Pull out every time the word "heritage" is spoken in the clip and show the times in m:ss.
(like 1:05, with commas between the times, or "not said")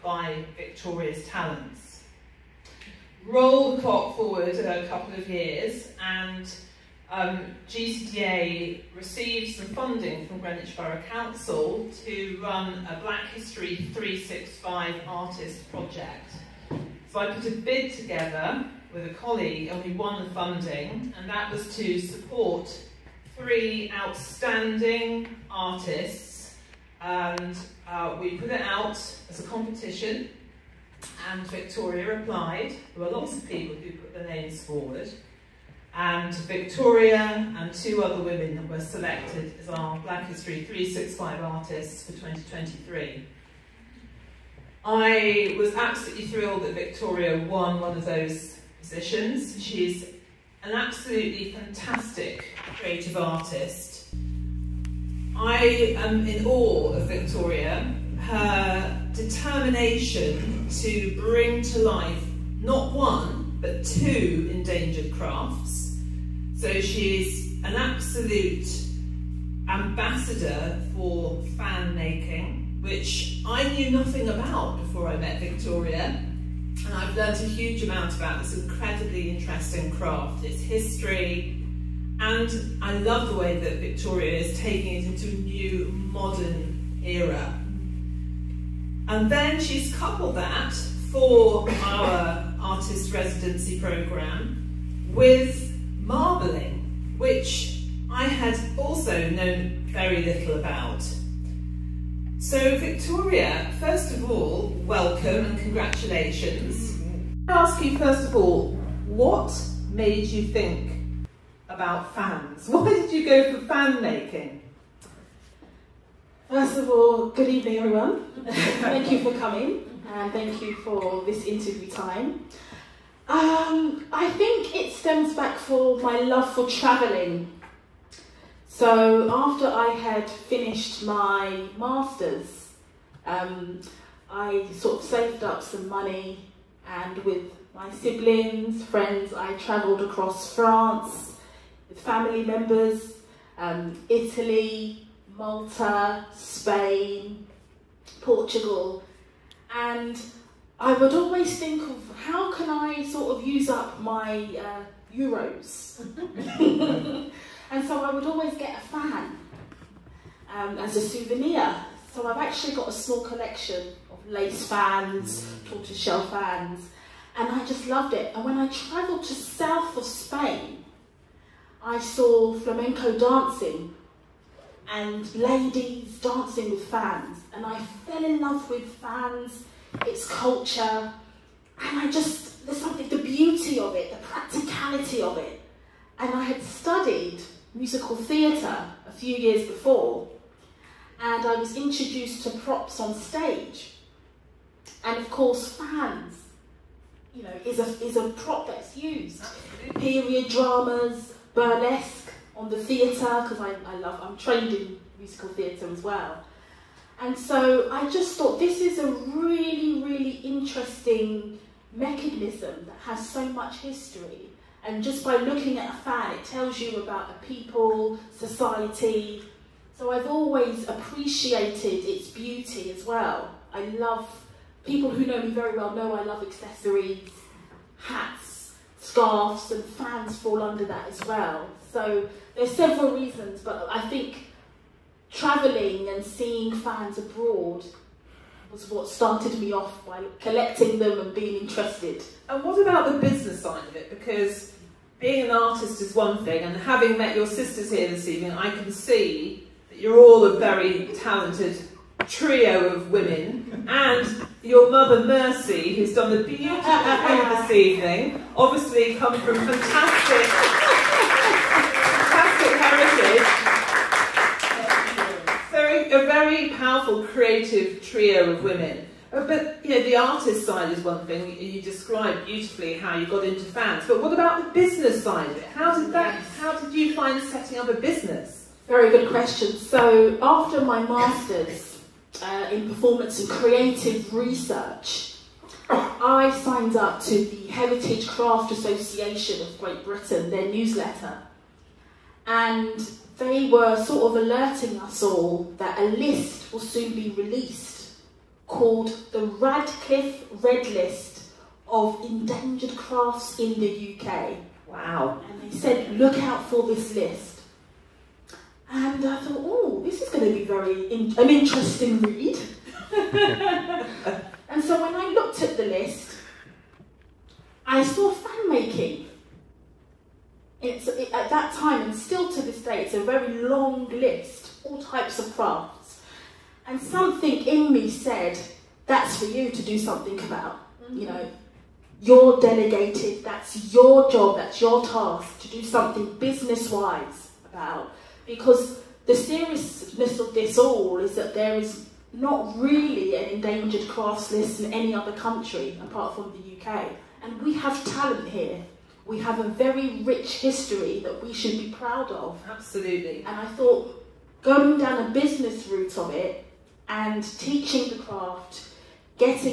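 4:25, 4:47.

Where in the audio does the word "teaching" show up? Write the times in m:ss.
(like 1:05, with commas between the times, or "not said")
5:57.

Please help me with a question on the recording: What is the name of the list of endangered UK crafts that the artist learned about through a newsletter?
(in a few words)
Radcliffe Red List.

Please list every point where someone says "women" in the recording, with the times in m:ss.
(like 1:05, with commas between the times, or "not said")
0:38, 4:13, 4:28.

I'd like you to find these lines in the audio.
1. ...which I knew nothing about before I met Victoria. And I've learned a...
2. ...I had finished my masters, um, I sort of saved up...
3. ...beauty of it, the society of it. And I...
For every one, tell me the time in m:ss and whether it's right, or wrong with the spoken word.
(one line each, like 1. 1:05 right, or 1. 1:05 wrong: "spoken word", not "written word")
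1. 1:12 right
2. 2:09 right
3. 3:03 wrong: "practicality", not "society".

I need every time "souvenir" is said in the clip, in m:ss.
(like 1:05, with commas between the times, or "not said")
2:40.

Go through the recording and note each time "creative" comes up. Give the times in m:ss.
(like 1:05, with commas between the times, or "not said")
0:52, 4:27, 4:43.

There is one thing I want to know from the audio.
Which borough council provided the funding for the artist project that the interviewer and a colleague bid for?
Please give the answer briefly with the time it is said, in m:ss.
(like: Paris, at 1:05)
Greenwich, at 0:10.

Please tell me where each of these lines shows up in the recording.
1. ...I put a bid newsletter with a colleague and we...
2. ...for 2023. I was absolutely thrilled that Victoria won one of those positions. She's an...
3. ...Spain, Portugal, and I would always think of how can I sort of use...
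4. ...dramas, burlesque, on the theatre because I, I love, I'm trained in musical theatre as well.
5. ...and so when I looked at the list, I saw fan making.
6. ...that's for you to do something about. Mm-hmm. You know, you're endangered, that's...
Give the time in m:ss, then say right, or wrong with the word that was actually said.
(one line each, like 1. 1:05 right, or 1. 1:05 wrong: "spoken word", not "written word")
1. 0:17 wrong: "together", not "newsletter"
2. 0:42 right
3. 2:26 right
4. 3:20 right
5. 5:13 right
6. 5:29 wrong: "delegated", not "endangered".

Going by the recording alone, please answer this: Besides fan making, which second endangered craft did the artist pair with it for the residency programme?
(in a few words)
marbling.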